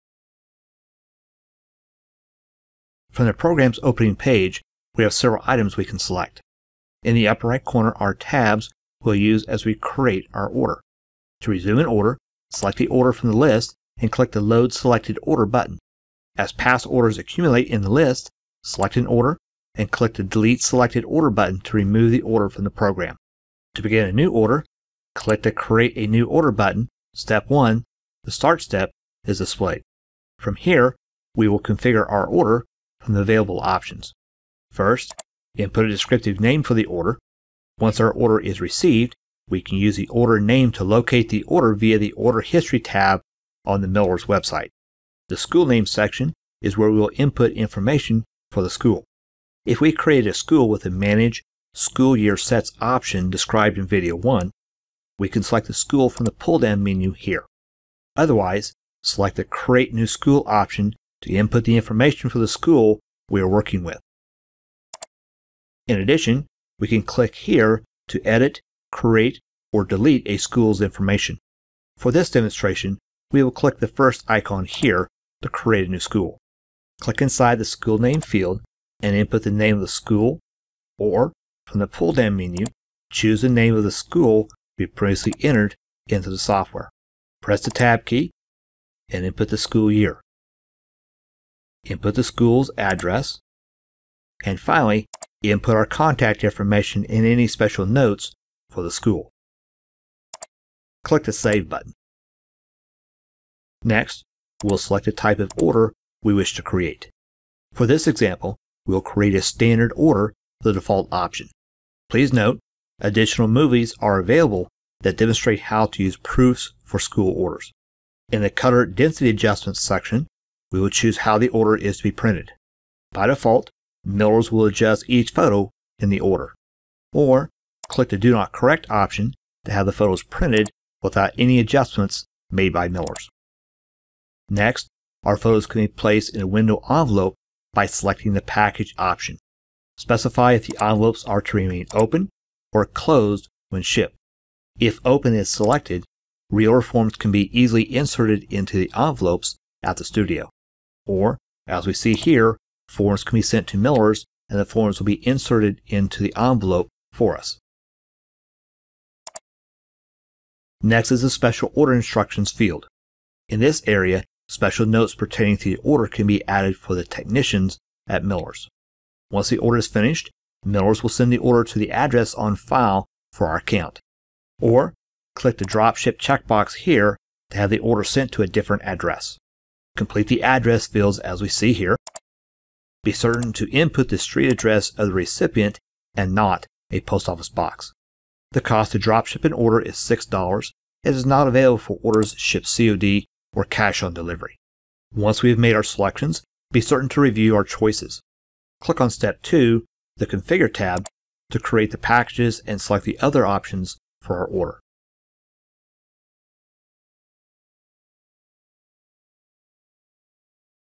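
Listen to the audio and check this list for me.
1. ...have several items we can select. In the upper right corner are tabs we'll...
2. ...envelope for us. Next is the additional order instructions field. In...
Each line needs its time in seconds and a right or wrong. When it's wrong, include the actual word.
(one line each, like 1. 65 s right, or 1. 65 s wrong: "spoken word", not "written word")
1. 5 s right
2. 156 s wrong: "special", not "additional".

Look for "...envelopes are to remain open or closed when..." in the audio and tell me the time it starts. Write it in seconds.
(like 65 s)
140 s.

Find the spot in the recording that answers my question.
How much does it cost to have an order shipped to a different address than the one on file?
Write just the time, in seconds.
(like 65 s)
189 s.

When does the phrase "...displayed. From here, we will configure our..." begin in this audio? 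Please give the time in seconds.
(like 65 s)
29 s.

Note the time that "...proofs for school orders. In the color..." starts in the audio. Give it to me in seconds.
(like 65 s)
116 s.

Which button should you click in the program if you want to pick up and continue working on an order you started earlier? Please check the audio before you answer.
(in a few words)
Load Selected Order.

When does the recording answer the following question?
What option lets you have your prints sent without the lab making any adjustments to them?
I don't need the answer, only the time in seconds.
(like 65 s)
128 s.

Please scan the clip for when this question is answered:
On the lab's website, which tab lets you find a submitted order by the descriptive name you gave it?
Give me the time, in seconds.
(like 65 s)
42 s.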